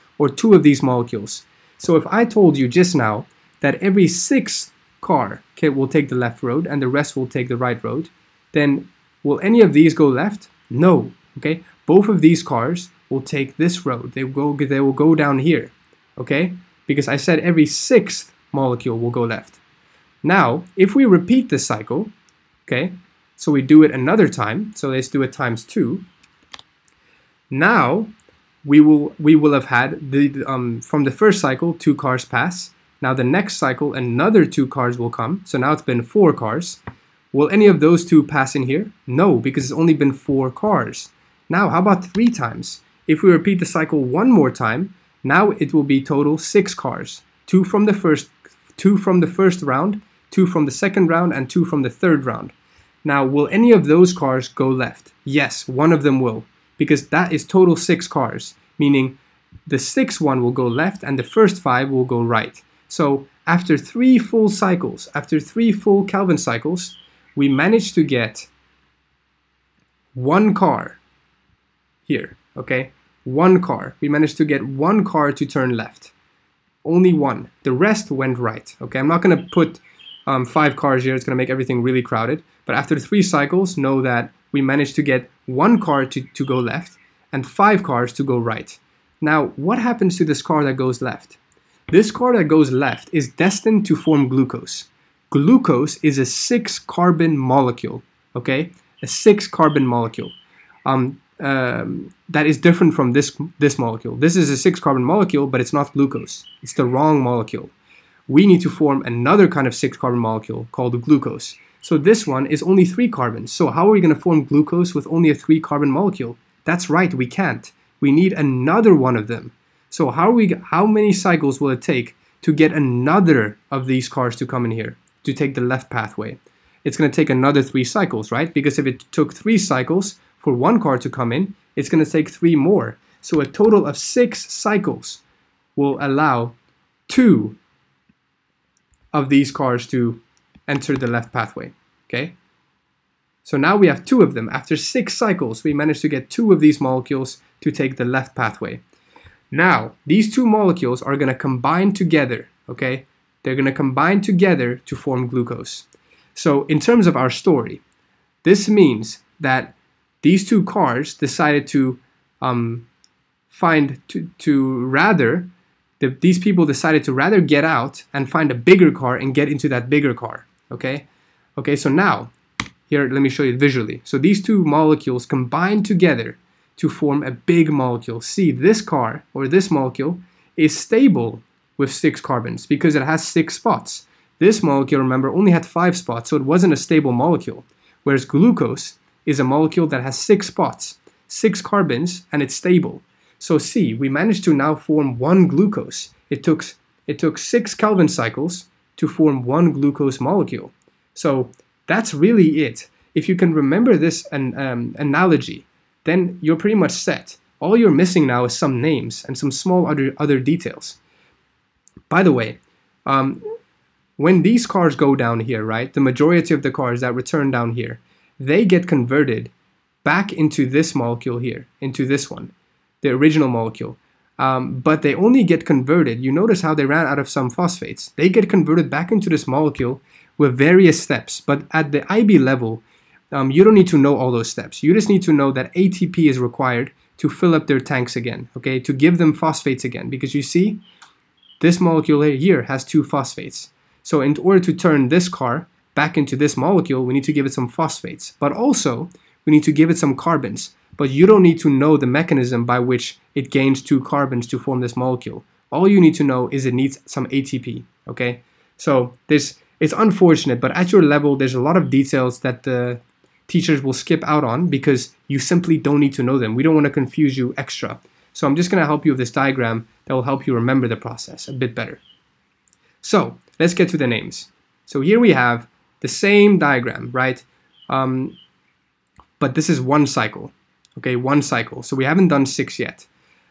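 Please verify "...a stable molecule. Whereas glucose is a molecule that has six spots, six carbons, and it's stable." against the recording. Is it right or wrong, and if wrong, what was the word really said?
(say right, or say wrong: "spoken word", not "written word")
right.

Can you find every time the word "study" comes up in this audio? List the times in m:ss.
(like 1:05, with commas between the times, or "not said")
not said.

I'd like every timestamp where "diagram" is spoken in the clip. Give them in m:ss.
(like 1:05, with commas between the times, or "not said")
4:29, 4:36.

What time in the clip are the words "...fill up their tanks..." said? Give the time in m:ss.
3:57.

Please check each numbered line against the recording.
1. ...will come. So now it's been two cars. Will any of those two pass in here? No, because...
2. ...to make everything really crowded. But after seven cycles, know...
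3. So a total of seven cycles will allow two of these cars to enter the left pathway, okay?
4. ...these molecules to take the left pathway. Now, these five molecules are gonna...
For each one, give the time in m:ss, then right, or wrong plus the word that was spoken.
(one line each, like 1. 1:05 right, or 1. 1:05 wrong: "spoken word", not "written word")
1. 0:34 wrong: "four", not "two"
2. 1:21 wrong: "three", not "seven"
3. 2:13 wrong: "six", not "seven"
4. 2:26 wrong: "two", not "five".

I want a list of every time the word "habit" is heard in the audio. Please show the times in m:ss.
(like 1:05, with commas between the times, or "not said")
not said.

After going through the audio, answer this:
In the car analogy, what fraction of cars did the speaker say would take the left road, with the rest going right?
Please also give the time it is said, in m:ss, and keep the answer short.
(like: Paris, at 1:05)
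Every sixth car, at 0:03.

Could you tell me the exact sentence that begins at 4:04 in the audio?
So in order to turn this car back into this molecule, we need to give it some phosphates.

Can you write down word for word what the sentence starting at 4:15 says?
All you need to know is it needs some ATP, okay?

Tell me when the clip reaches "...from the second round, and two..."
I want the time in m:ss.
0:50.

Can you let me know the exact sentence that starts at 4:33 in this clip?
So let's get to the names.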